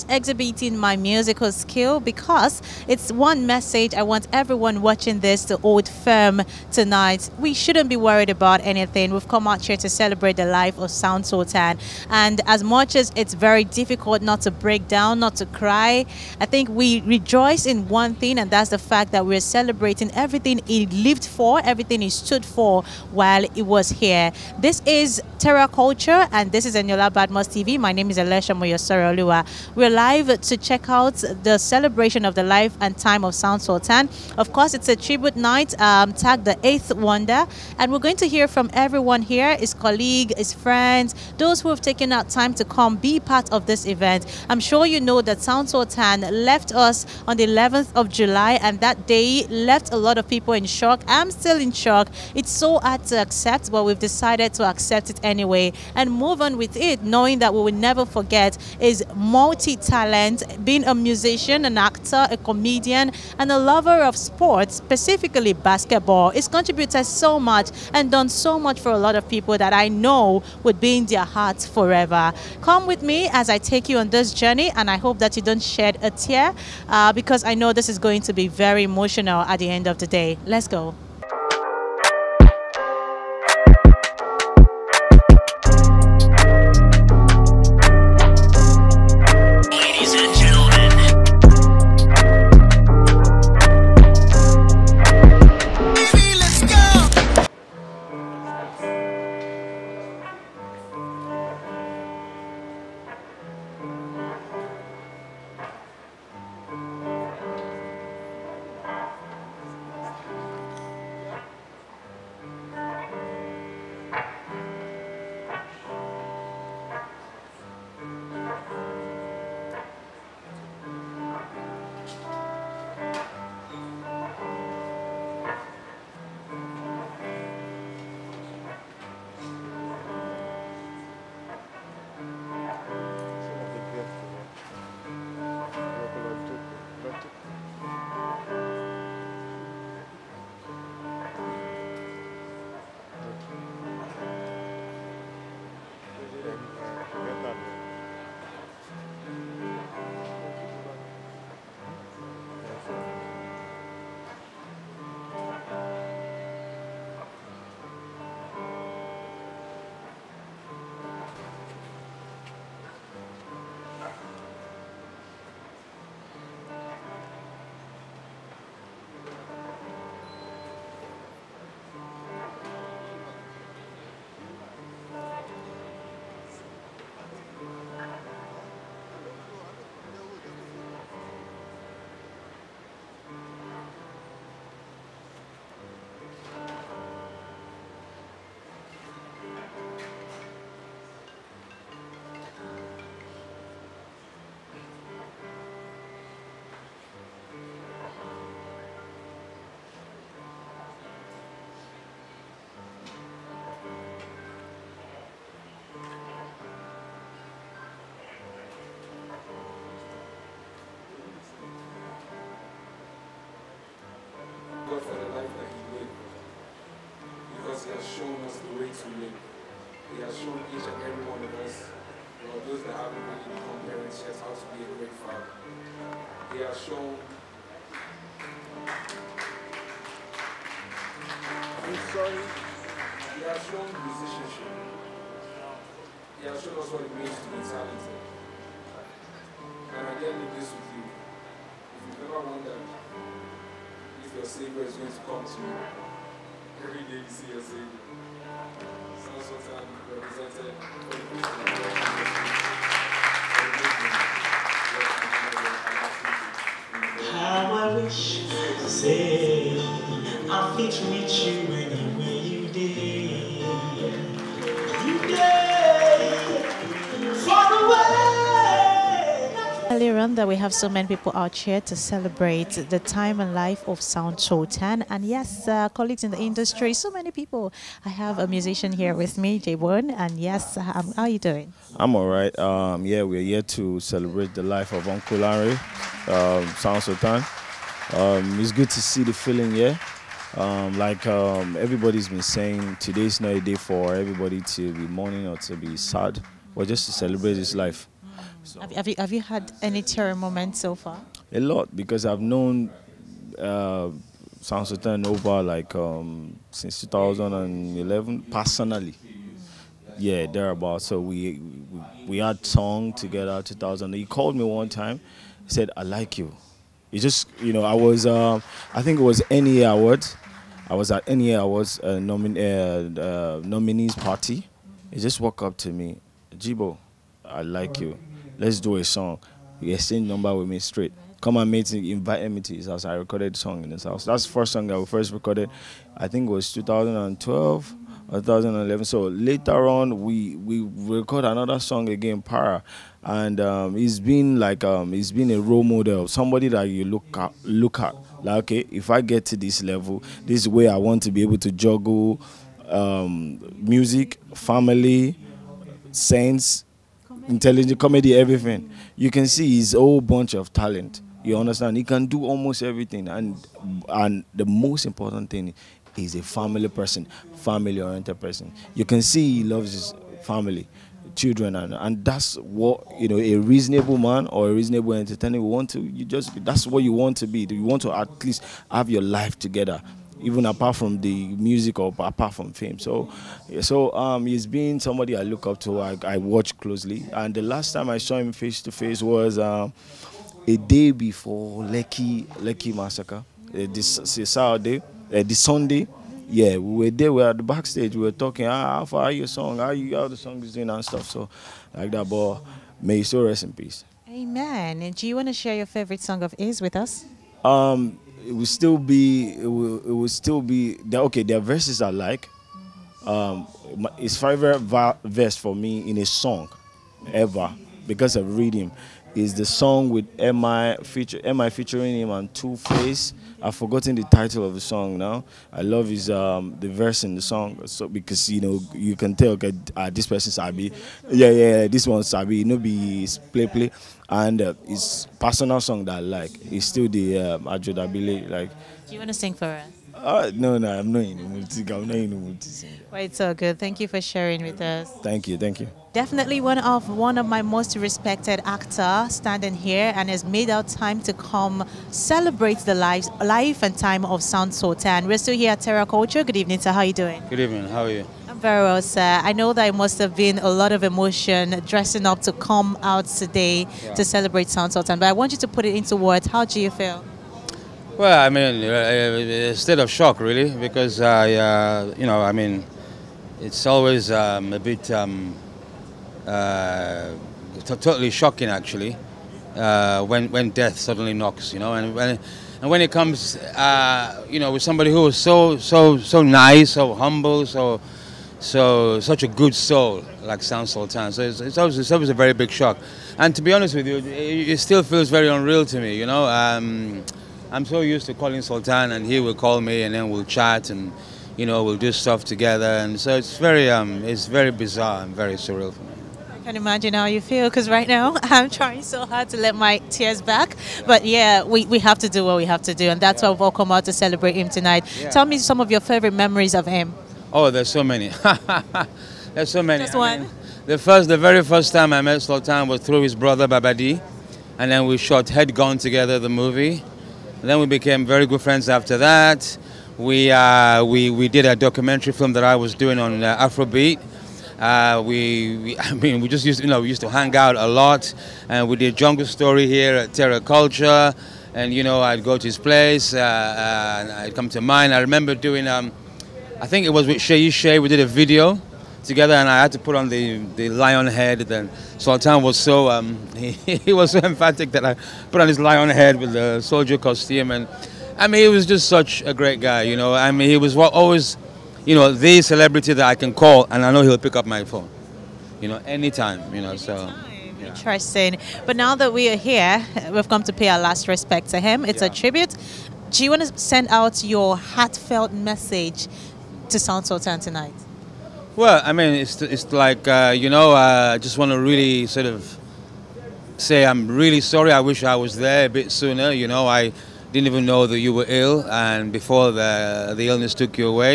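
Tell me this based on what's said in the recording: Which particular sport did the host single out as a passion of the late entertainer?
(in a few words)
Basketball.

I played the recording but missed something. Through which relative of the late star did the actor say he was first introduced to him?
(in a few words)
Baba Dee.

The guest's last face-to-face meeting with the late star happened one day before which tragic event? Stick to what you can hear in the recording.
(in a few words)
Lekki massacre.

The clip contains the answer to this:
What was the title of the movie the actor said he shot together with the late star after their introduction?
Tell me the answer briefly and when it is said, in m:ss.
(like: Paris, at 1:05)
Head Gone, at 8:45.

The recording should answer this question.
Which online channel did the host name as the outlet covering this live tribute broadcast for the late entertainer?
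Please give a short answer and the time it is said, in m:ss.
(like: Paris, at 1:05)
Badmus TV, at 0:27.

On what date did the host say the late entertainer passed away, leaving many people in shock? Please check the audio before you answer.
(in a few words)
11 July.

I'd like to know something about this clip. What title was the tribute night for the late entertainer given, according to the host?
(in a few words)
The Eighth Wonder.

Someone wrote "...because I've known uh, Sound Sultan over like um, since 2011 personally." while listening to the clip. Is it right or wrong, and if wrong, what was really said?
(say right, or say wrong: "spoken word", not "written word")
right.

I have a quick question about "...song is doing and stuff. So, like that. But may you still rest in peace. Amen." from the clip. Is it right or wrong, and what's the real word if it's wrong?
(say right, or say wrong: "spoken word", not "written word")
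right.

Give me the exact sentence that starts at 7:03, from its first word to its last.
I've forgotten the title of the song now.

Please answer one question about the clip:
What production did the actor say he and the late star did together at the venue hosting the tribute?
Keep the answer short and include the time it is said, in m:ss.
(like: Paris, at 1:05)
Jungle Story, at 8:59.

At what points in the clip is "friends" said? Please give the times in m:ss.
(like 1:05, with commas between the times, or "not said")
0:40, 8:48.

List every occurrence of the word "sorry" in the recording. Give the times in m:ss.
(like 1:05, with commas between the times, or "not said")
3:52, 9:44.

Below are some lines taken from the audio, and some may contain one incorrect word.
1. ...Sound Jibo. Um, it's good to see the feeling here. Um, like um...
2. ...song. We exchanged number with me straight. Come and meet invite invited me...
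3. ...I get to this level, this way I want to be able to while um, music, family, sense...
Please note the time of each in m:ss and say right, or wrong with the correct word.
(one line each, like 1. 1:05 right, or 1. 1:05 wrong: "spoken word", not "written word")
1. 4:46 wrong: "Sultan", not "Jibo"
2. 5:29 right
3. 5:49 wrong: "juggle", not "while".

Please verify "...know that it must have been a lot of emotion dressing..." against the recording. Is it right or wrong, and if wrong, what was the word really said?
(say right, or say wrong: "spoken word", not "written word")
right.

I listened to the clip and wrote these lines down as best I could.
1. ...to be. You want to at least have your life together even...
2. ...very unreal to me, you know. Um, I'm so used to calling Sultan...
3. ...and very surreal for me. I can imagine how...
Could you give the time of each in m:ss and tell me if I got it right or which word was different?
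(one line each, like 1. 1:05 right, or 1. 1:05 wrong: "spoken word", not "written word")
1. 6:17 right
2. 8:15 right
3. 8:25 right.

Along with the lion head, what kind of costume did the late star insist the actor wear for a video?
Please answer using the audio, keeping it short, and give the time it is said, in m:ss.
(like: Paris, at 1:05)
Soldier costume, at 9:16.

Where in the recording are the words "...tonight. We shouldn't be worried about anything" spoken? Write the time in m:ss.
0:06.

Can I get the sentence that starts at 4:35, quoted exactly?
And yes, uh, colleagues in the industry, so many people.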